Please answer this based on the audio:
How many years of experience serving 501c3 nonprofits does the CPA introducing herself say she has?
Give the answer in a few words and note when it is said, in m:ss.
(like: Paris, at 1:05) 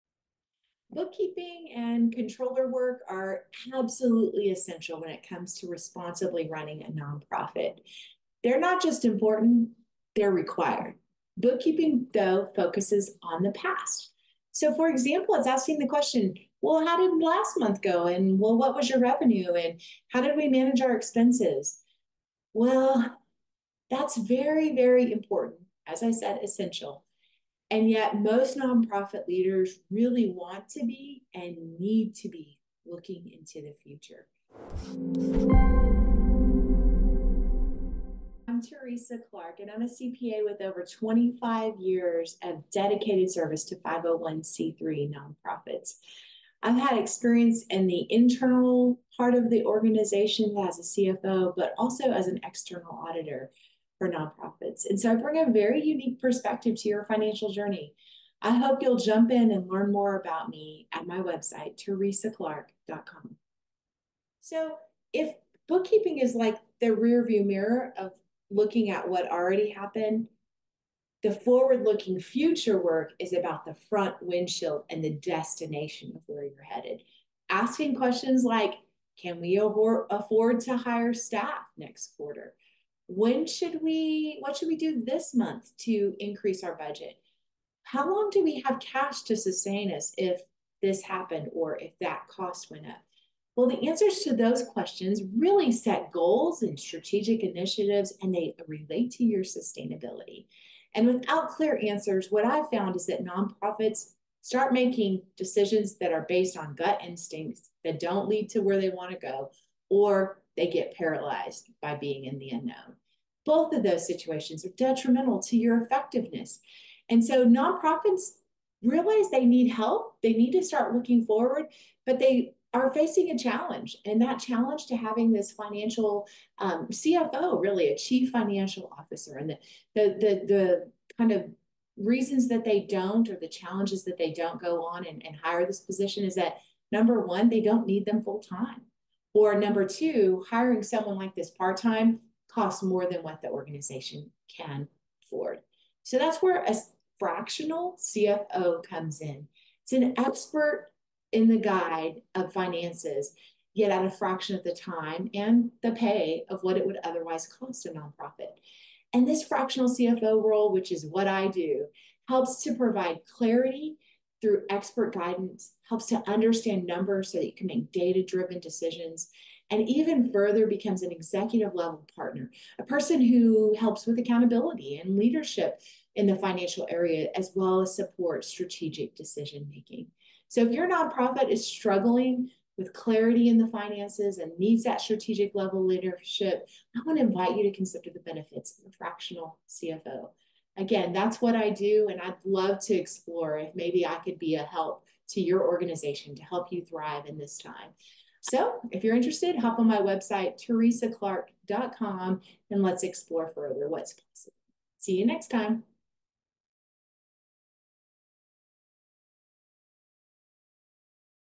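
25, at 0:40.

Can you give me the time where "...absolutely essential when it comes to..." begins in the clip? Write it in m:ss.
0:03.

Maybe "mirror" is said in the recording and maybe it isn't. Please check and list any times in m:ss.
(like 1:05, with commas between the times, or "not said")
1:07.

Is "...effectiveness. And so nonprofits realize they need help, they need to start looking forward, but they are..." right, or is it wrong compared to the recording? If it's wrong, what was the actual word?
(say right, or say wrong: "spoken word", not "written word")
right.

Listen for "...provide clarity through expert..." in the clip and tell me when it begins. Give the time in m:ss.
2:42.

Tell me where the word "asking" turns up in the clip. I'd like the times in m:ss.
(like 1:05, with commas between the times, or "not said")
0:15, 1:17.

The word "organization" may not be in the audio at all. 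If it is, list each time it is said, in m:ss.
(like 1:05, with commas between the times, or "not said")
0:49, 2:23, 3:15.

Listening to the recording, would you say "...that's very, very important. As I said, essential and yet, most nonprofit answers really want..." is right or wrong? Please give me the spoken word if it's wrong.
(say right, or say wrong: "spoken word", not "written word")
wrong: "leaders", not "answers".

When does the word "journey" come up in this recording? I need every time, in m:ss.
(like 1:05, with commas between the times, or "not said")
0:57.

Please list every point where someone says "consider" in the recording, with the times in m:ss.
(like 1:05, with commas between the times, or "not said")
3:07.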